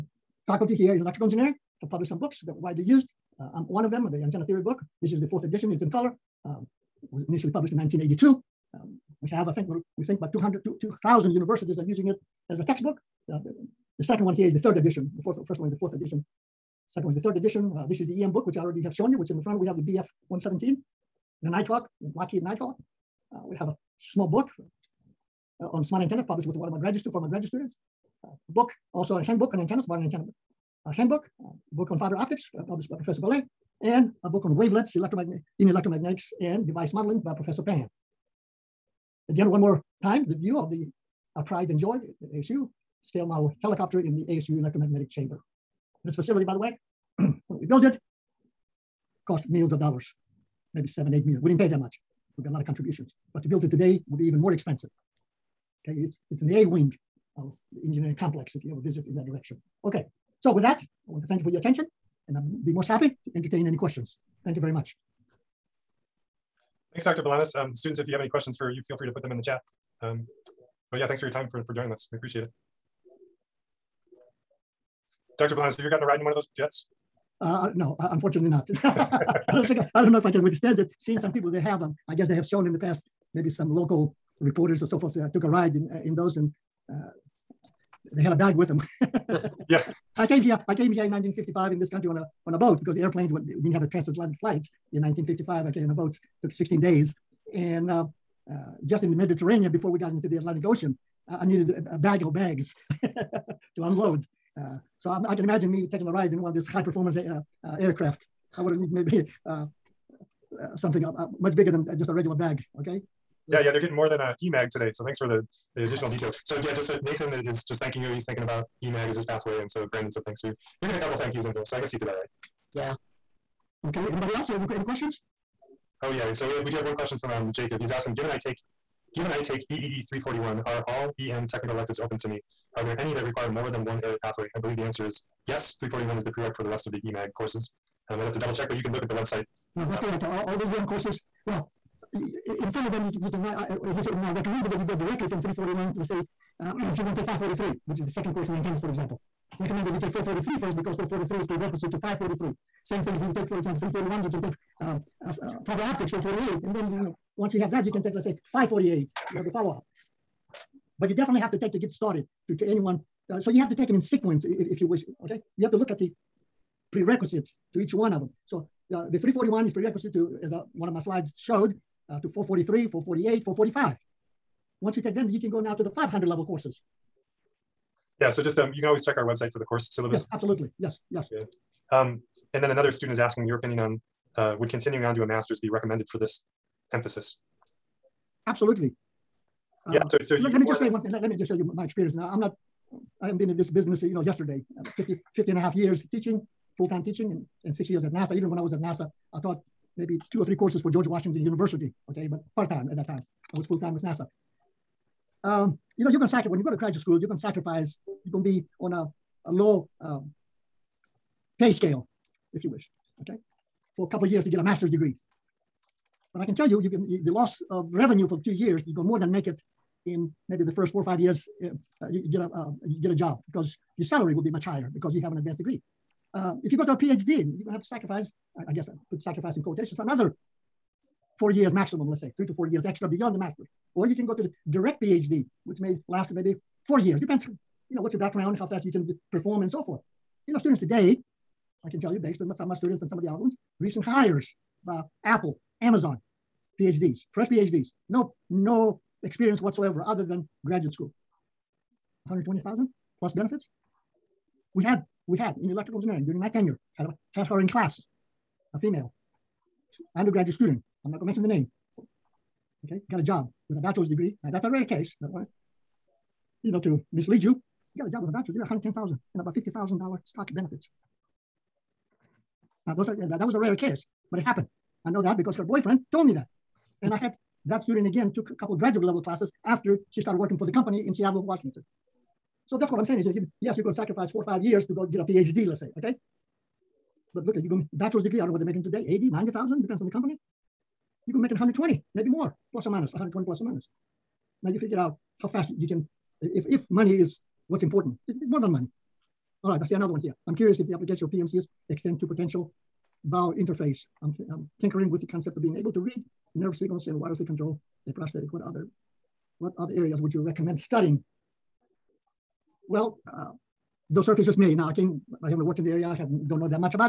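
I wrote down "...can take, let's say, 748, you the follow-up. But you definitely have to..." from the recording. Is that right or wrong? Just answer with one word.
wrong.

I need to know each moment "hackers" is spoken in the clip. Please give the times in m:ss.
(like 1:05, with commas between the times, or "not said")
not said.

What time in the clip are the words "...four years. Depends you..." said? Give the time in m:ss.
3:56.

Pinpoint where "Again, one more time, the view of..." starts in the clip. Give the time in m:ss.
0:39.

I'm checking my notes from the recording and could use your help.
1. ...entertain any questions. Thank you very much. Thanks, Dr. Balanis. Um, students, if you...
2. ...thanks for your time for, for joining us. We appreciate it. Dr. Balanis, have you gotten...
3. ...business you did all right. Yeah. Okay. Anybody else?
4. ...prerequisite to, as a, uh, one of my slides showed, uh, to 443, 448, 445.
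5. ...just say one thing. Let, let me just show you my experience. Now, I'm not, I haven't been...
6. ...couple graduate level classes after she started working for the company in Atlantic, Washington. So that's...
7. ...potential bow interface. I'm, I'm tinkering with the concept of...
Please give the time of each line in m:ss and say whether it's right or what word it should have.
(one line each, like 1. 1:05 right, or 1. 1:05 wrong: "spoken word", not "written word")
1. 1:03 right
2. 1:11 right
3. 2:01 wrong: "guess", not "business"
4. 2:49 right
5. 3:10 right
6. 4:38 wrong: "Seattle", not "Atlantic"
7. 5:02 right.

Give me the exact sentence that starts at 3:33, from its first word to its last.
For a couple of years to get a master's degree.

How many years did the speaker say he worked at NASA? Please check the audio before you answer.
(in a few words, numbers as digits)
6.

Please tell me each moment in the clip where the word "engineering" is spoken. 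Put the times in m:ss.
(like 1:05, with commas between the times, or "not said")
0:01, 0:57, 4:15.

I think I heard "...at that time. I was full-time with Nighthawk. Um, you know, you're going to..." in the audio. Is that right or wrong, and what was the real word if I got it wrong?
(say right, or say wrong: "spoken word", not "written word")
wrong: "NASA", not "Nighthawk".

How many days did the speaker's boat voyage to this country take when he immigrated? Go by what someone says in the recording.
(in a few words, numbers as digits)
16 days.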